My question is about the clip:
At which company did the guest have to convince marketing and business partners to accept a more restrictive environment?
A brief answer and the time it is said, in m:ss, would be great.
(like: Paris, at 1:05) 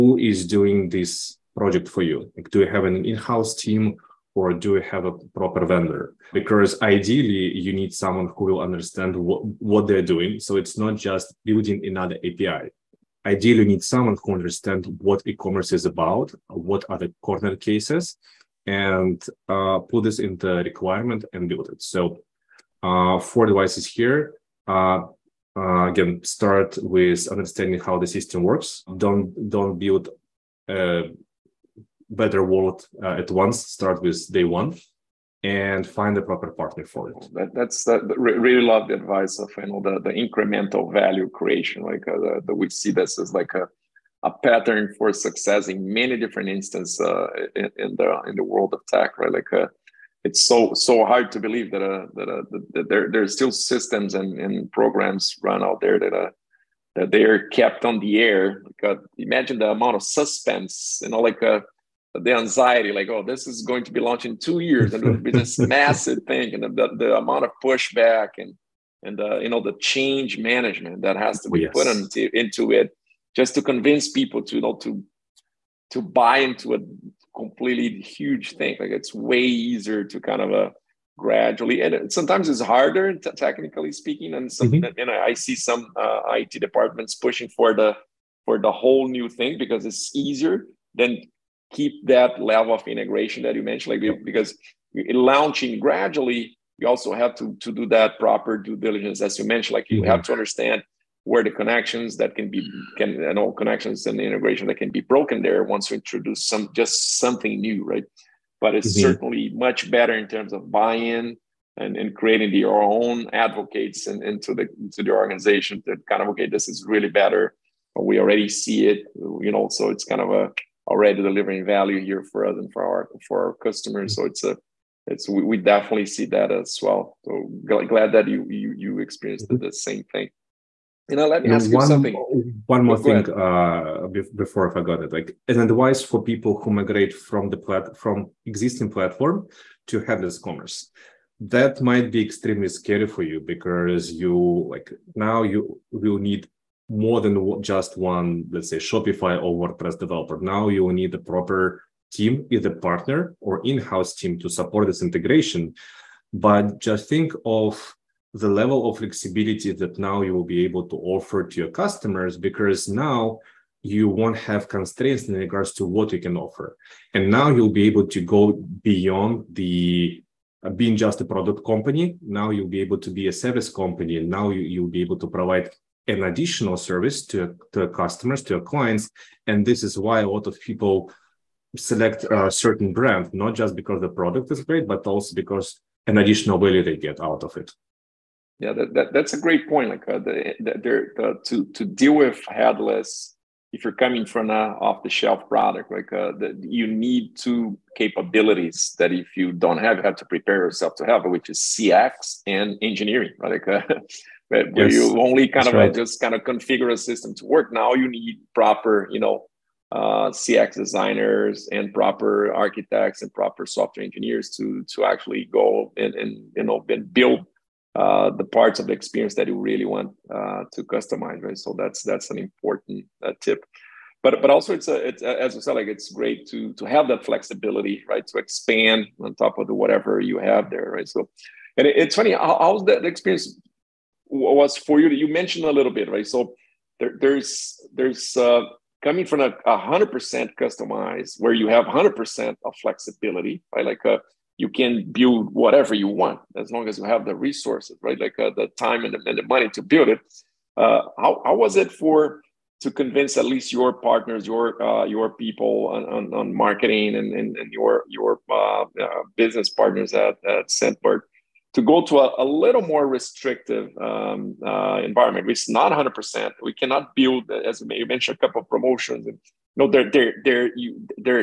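Scentbird, at 4:20.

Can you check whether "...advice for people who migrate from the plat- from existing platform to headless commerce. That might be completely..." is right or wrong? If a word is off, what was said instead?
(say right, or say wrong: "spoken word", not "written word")
wrong: "extremely", not "completely".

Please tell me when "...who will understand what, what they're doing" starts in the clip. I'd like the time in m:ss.
0:08.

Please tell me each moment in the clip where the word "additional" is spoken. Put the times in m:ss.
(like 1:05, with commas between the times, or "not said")
2:56, 3:06.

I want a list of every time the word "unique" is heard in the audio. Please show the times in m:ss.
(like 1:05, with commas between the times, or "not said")
not said.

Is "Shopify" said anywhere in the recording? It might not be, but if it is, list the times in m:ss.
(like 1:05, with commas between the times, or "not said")
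2:28.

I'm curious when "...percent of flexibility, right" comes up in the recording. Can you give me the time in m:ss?
4:02.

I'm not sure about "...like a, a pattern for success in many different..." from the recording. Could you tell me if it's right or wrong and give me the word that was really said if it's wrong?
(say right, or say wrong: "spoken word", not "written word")
right.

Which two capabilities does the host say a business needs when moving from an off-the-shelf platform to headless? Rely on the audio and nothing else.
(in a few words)
CX and engineering.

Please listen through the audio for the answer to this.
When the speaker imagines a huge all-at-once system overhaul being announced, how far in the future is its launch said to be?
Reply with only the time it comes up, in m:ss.
1:04.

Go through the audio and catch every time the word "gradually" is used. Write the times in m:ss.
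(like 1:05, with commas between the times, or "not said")
1:21, 1:35.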